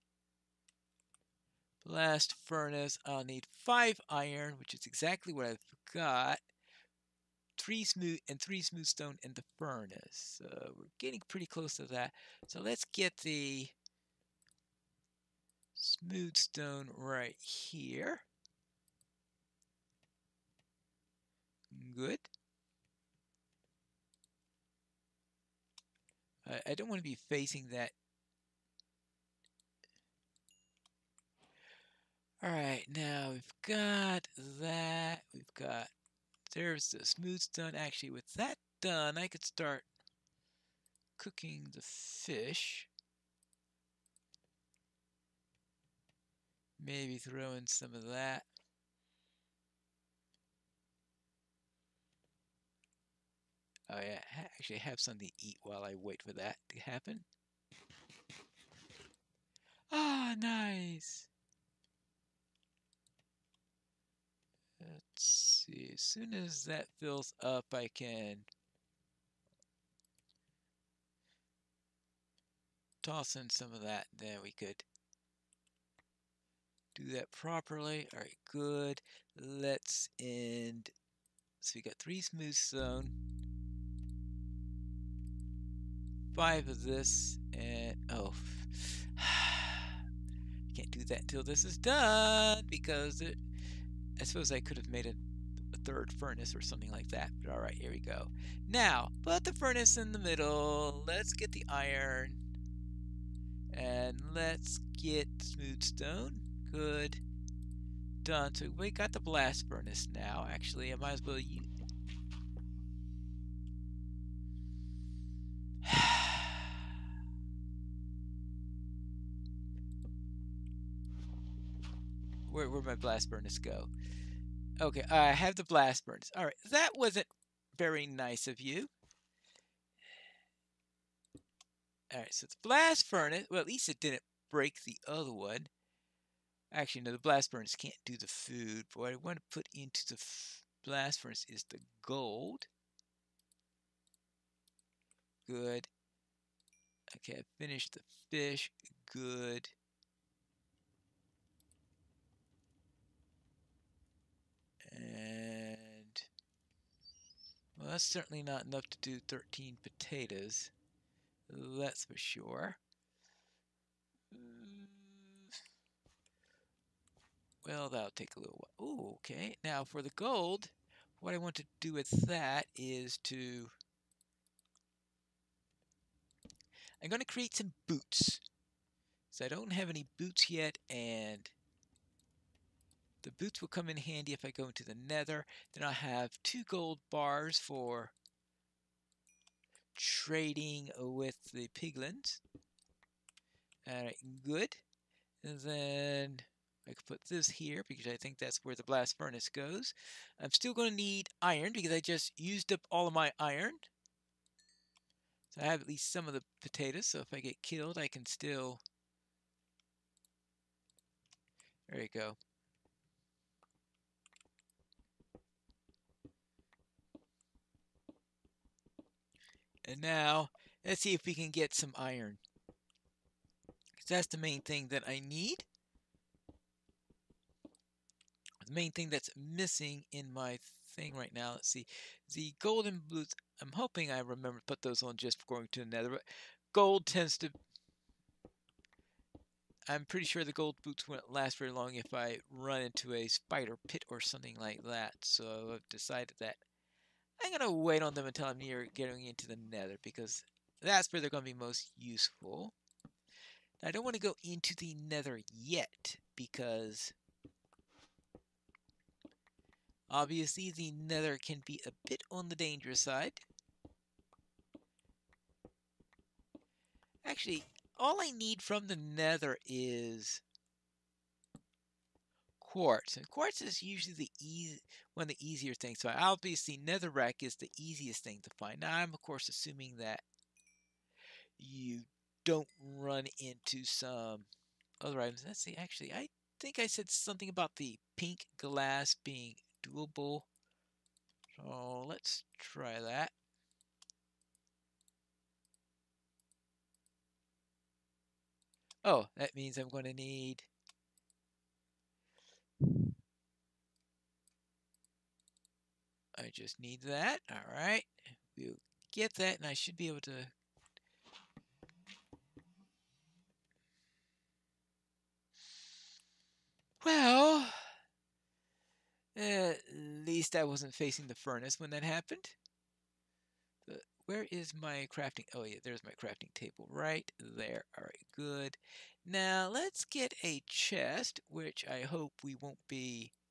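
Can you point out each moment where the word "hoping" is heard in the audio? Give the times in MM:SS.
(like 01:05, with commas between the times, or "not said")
03:53.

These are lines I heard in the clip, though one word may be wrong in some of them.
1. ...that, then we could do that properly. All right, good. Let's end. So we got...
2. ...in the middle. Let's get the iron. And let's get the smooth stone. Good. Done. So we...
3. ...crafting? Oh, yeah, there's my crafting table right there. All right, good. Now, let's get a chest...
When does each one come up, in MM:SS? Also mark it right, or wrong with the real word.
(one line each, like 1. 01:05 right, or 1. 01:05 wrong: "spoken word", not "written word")
1. 01:13 right
2. 01:39 right
3. 05:25 right.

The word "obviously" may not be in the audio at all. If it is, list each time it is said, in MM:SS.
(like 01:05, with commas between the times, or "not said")
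04:20, 04:36.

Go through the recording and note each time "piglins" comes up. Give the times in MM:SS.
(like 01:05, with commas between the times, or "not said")
03:11.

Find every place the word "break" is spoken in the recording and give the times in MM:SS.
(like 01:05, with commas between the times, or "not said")
02:14.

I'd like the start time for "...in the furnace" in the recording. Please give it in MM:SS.
00:09.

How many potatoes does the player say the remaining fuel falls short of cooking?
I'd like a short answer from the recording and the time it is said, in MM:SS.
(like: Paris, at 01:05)
13, at 02:39.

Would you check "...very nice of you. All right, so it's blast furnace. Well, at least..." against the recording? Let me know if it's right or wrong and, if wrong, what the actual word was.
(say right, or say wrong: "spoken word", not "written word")
right.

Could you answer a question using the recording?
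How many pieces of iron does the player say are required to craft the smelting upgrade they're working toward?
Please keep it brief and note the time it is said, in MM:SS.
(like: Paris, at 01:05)
5, at 00:03.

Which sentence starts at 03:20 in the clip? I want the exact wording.
I'm still going to need iron because I just used up all of my iron.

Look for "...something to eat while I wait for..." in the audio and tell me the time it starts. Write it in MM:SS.
00:54.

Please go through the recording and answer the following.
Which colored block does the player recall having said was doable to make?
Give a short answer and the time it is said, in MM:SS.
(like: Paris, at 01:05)
Pink glass, at 04:48.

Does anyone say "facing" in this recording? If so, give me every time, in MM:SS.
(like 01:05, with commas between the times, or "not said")
00:27, 05:20.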